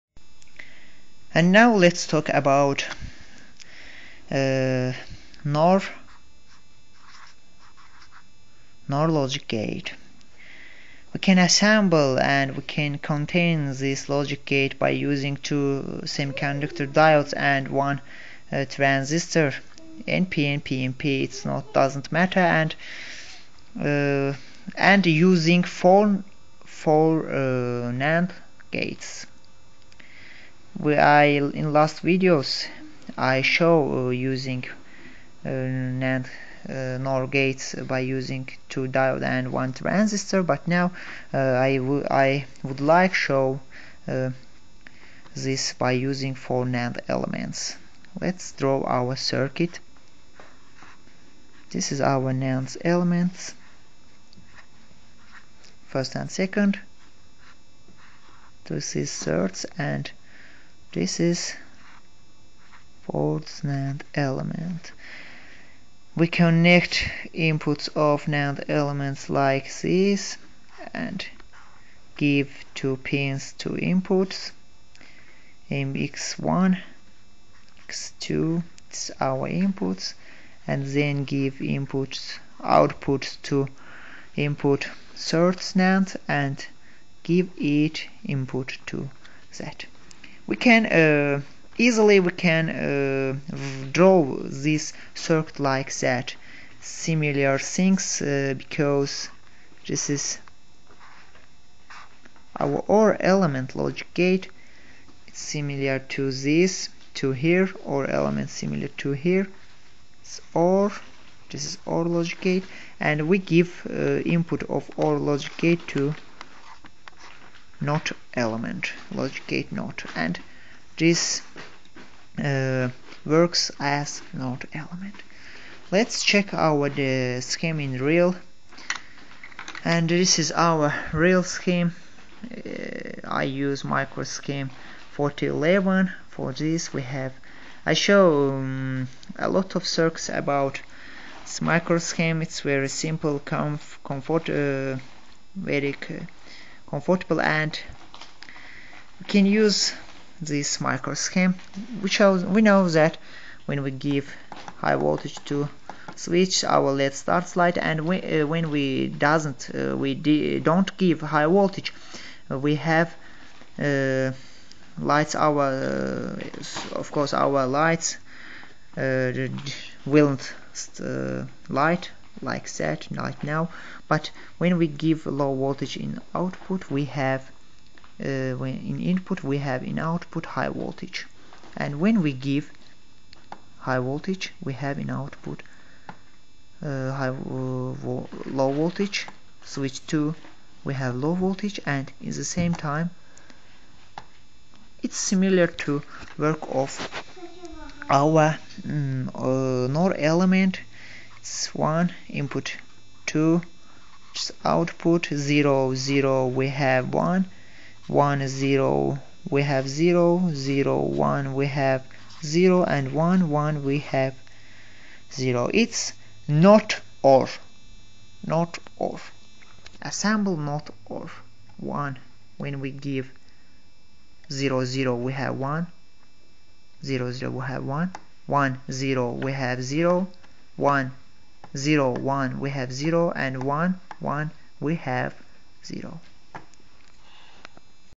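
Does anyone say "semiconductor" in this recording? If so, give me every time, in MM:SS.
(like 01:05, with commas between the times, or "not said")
00:16.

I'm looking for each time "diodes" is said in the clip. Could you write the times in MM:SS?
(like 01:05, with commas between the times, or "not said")
00:16.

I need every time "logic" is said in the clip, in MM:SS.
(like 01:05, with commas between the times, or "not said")
00:09, 00:14.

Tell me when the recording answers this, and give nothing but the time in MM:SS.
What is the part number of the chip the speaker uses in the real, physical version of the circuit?
02:15.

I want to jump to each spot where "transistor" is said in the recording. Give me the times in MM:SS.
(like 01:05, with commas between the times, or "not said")
00:18.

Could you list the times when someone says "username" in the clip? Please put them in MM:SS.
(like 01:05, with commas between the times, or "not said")
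not said.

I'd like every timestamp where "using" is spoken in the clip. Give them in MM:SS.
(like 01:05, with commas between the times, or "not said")
00:14.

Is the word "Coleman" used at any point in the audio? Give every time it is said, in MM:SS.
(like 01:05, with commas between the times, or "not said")
not said.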